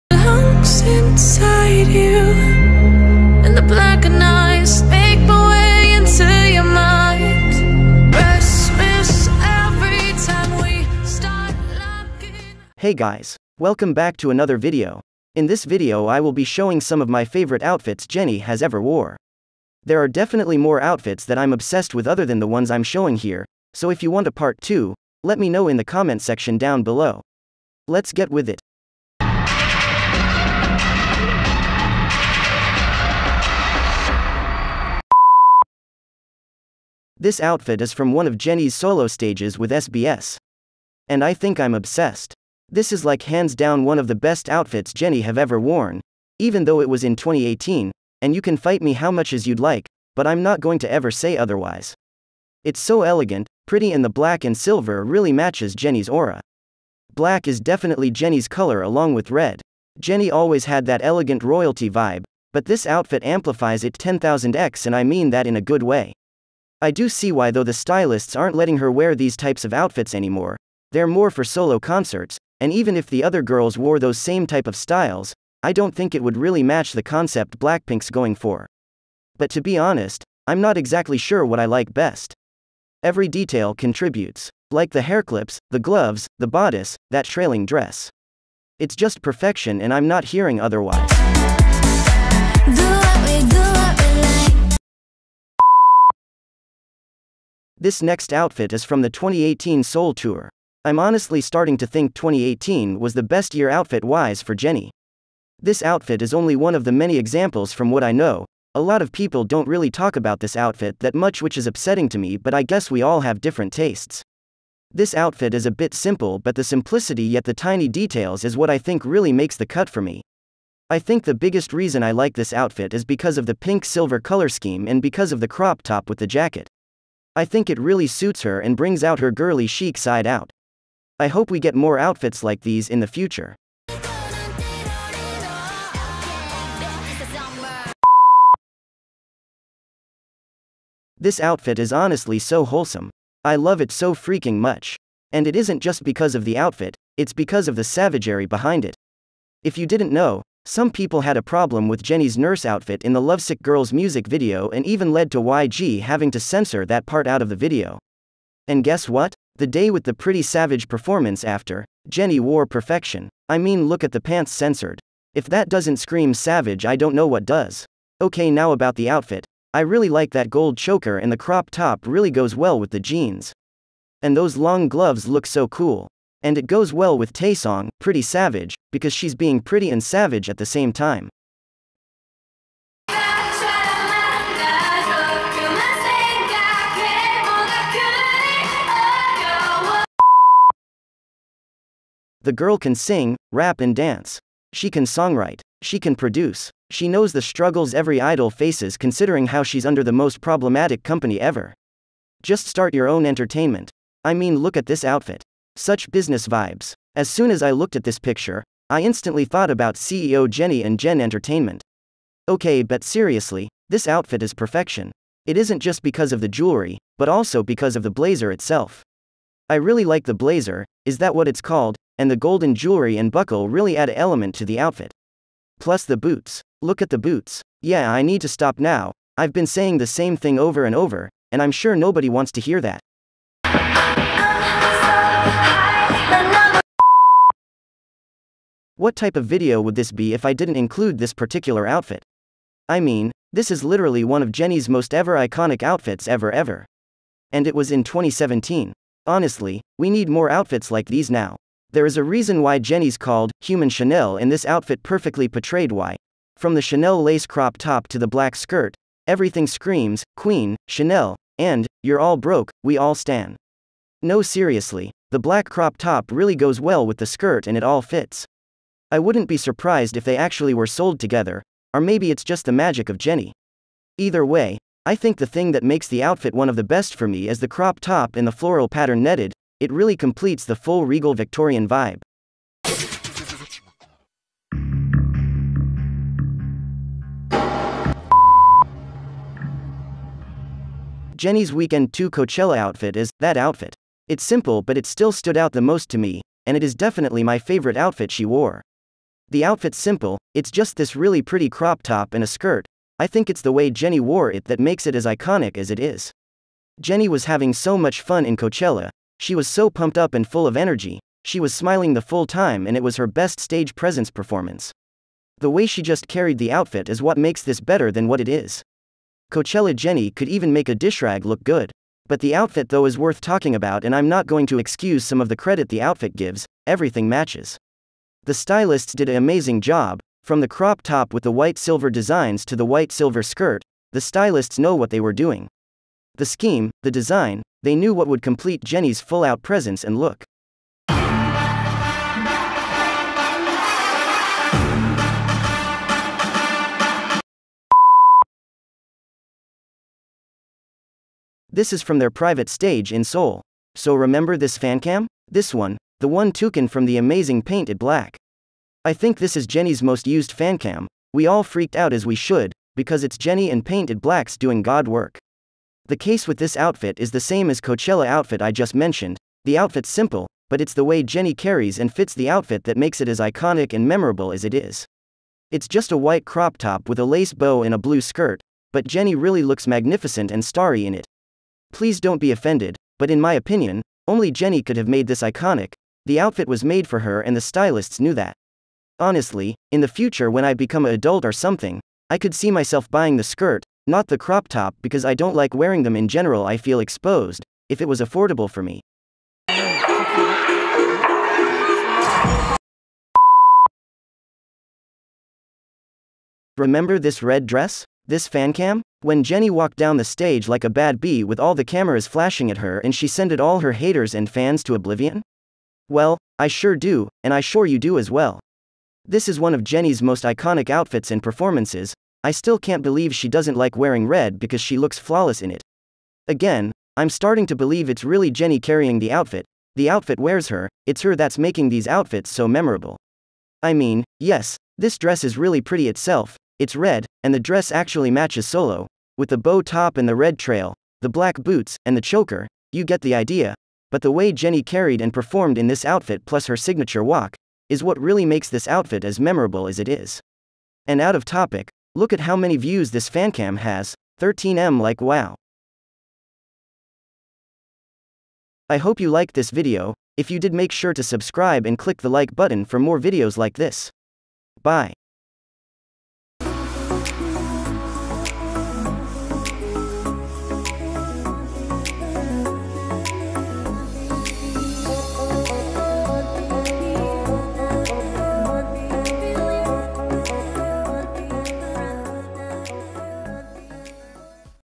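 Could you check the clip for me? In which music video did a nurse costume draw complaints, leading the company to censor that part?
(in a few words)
Lovesick Girls.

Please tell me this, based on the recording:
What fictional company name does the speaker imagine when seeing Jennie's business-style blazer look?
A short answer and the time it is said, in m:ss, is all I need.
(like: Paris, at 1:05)
Jen Entertainment, at 3:30.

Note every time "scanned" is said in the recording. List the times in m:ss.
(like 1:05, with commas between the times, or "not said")
not said.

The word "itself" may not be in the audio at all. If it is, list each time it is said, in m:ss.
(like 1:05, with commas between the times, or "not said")
3:38, 7:16.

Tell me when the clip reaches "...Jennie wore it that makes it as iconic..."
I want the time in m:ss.
5:03.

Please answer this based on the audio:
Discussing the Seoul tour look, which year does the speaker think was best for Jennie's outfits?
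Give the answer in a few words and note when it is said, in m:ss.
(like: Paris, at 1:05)
2018, at 1:42.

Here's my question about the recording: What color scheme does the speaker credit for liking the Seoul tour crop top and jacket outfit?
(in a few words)
Pink silver.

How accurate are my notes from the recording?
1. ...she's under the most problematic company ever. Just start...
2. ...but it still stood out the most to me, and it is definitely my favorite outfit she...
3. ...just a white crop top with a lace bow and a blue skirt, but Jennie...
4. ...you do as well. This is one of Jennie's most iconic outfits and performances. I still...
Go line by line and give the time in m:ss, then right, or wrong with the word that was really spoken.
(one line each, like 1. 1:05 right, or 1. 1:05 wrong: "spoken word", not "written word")
1. 3:19 right
2. 4:54 right
3. 6:15 right
4. 6:57 right.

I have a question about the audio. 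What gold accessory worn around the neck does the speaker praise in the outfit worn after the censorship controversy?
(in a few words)
Gold choker.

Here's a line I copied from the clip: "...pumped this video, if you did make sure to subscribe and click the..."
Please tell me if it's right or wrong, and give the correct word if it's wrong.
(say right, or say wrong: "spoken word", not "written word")
wrong: "liked", not "pumped".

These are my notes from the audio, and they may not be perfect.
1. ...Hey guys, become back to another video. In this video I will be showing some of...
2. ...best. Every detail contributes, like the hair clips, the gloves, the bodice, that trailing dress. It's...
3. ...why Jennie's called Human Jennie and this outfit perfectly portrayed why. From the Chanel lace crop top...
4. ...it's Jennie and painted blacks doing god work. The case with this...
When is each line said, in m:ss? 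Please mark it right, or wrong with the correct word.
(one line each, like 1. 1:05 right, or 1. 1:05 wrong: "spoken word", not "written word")
1. 0:12 wrong: "welcome", not "become"
2. 1:21 right
3. 4:12 wrong: "Chanel", not "Jennie"
4. 6:03 right.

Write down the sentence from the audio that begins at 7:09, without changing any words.
The outfit wears her, it's her that's making these outfits so memorable.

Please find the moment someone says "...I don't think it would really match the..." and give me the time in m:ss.
1:15.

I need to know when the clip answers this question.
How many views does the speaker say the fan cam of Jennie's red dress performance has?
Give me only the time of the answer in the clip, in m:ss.
7:34.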